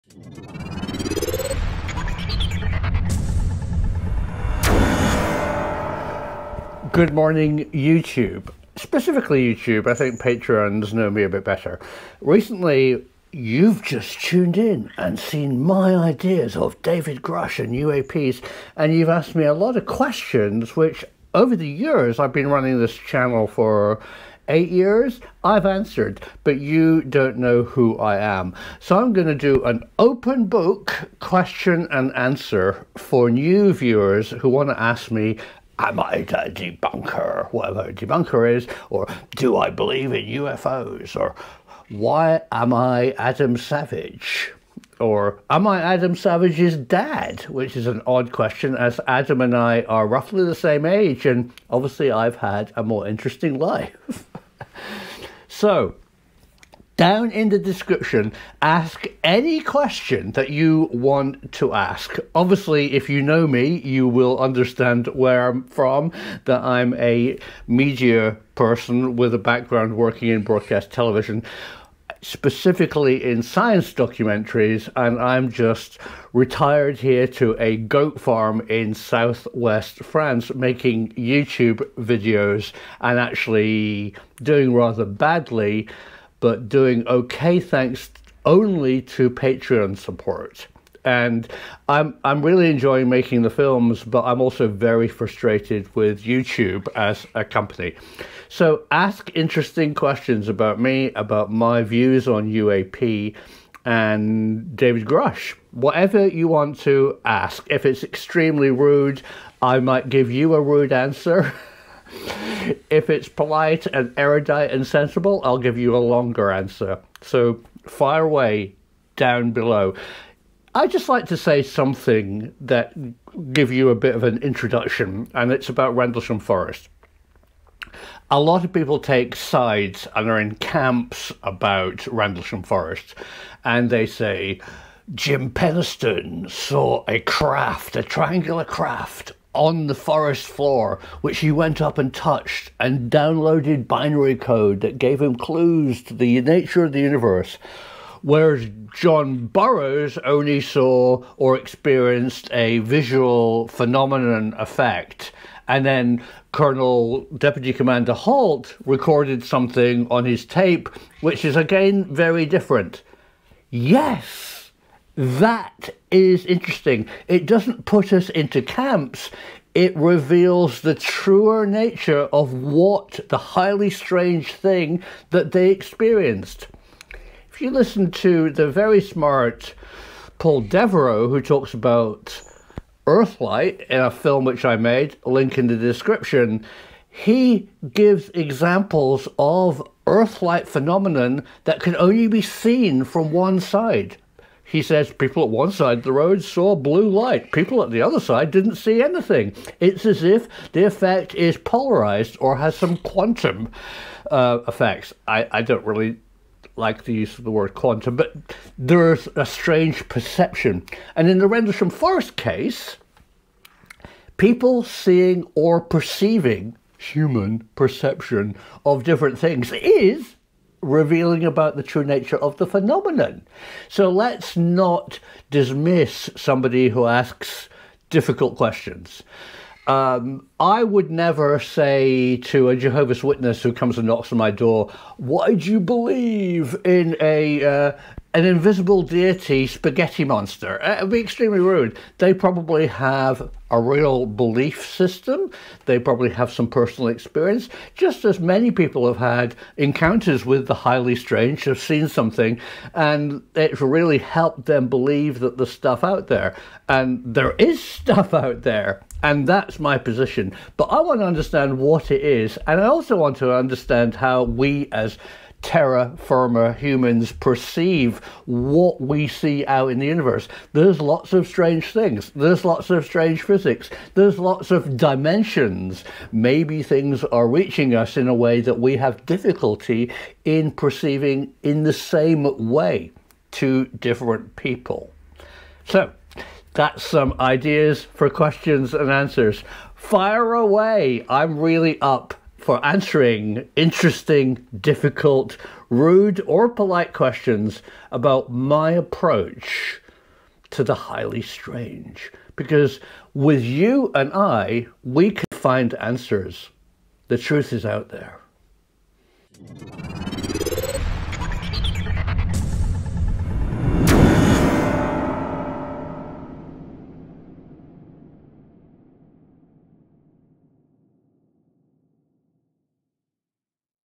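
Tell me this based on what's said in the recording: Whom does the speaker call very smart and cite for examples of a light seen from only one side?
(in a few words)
Paul Devereux.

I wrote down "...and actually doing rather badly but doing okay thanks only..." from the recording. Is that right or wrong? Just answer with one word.
right.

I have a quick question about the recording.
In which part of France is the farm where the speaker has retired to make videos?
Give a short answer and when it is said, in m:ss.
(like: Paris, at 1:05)
southwest France, at 1:18.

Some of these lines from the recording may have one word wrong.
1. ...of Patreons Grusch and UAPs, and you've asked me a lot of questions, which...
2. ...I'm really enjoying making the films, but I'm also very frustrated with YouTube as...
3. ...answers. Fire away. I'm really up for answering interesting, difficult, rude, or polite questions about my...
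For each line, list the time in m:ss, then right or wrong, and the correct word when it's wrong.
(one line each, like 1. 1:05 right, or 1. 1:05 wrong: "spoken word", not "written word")
1. 0:16 wrong: "David", not "Patreons"
2. 1:32 right
3. 4:49 right.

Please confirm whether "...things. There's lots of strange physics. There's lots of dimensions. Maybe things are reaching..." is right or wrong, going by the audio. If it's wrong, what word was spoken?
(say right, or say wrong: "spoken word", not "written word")
right.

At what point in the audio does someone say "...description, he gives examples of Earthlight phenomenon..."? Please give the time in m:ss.
3:05.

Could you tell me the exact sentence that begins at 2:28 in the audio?
Whereas John Burroughs only saw or experienced a visual phenomenon effect.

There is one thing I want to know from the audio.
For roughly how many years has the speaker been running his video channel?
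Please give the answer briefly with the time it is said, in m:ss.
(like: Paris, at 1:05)
8, at 0:24.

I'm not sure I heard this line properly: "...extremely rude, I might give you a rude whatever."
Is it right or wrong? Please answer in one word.
wrong.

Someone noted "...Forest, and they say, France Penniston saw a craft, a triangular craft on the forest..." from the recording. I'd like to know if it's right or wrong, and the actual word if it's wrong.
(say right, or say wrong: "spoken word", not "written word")
wrong: "Jim", not "France".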